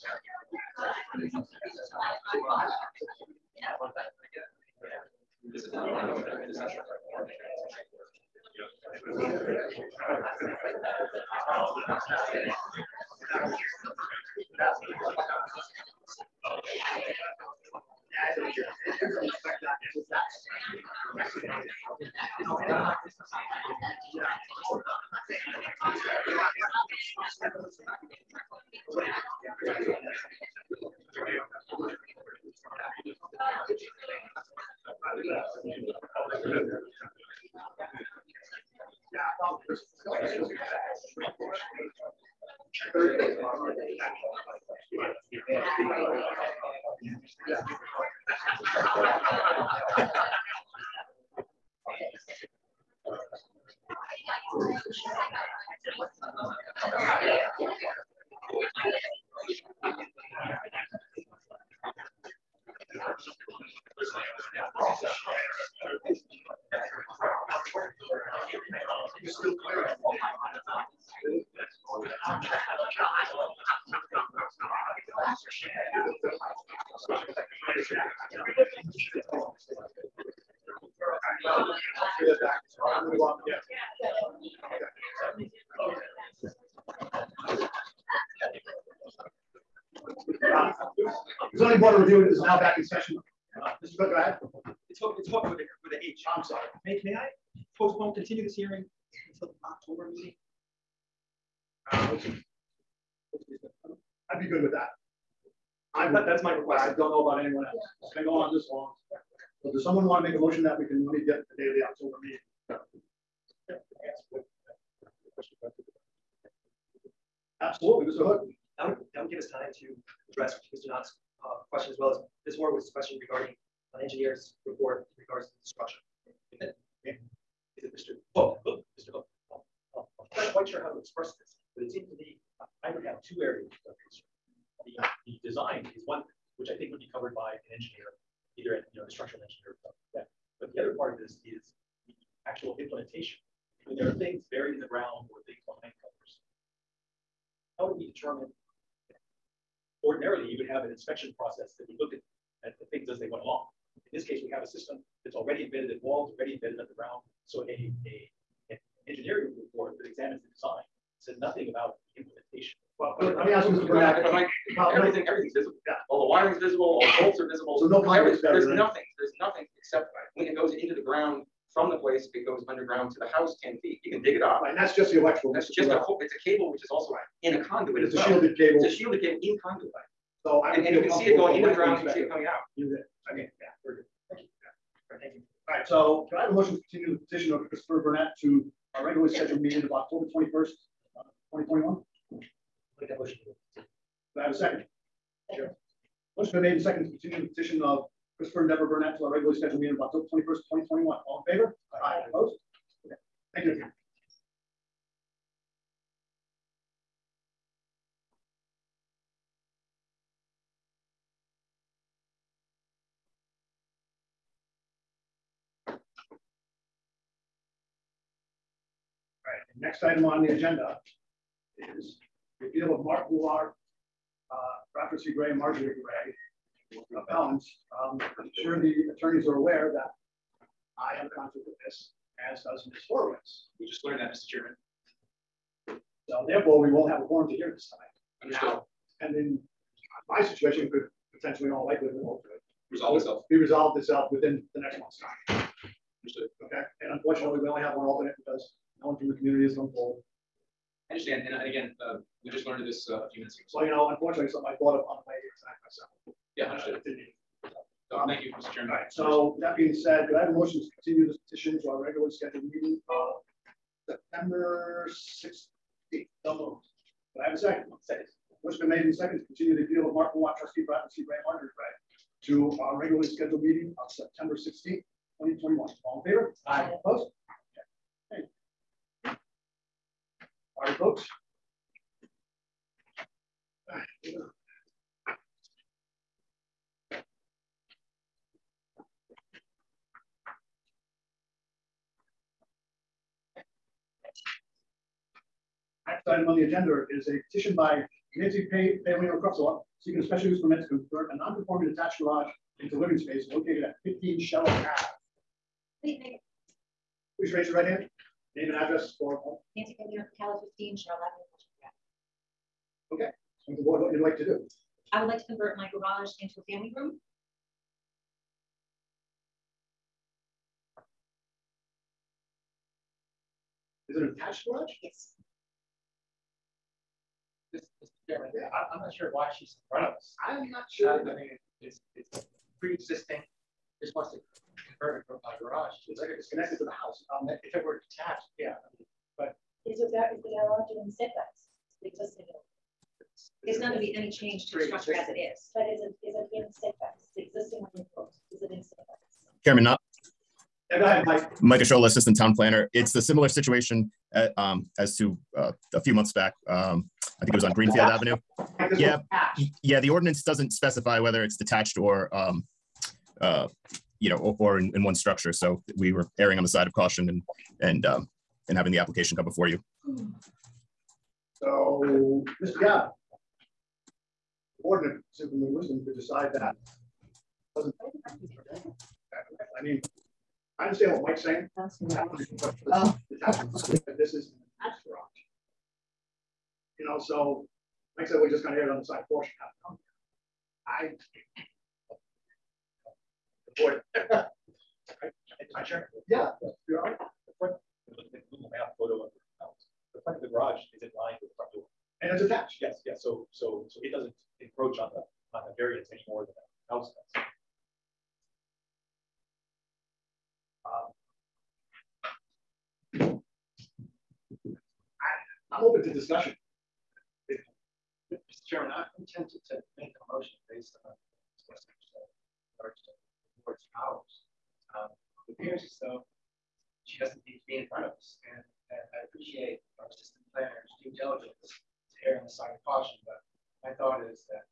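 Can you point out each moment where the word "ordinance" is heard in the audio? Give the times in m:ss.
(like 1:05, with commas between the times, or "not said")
6:00.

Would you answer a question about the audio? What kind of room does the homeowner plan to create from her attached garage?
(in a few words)
family room.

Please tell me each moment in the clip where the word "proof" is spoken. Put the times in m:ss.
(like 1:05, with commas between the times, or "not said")
not said.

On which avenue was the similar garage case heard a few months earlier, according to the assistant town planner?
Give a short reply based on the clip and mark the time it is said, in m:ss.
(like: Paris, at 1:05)
Greenfield Avenue, at 5:57.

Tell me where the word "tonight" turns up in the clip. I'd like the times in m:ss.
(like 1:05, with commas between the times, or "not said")
3:57, 4:15.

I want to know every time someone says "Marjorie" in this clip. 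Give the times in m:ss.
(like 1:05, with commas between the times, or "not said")
3:45, 4:31.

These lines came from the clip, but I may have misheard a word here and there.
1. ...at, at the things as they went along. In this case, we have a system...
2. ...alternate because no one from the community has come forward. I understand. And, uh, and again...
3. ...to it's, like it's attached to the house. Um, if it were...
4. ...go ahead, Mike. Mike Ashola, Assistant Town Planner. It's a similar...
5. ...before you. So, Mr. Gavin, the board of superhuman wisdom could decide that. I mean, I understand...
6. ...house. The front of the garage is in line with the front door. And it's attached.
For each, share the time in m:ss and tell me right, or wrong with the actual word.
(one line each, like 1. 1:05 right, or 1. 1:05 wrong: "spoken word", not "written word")
1. 2:32 right
2. 4:08 right
3. 5:36 wrong: "connected", not "attached"
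4. 5:50 right
5. 6:09 right
6. 6:39 right.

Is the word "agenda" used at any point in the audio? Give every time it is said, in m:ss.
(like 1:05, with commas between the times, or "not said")
3:40, 4:56.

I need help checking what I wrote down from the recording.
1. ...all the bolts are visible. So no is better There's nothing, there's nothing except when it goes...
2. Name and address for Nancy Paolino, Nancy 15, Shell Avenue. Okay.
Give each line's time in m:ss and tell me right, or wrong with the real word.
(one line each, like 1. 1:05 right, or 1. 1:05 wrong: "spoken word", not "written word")
1. 2:46 right
2. 5:08 wrong: "Cala", not "Nancy".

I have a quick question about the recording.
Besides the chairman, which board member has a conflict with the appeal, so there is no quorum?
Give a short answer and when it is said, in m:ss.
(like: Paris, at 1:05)
Ms. Horowitz, at 3:52.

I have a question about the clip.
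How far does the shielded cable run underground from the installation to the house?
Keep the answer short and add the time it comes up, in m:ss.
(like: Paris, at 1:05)
10 feet, at 2:53.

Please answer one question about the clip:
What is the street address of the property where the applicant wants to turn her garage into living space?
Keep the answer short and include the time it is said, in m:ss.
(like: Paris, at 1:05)
15 Shell Ave, at 5:04.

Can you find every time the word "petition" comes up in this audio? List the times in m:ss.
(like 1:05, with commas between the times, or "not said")
3:07, 3:17, 4:21, 4:57.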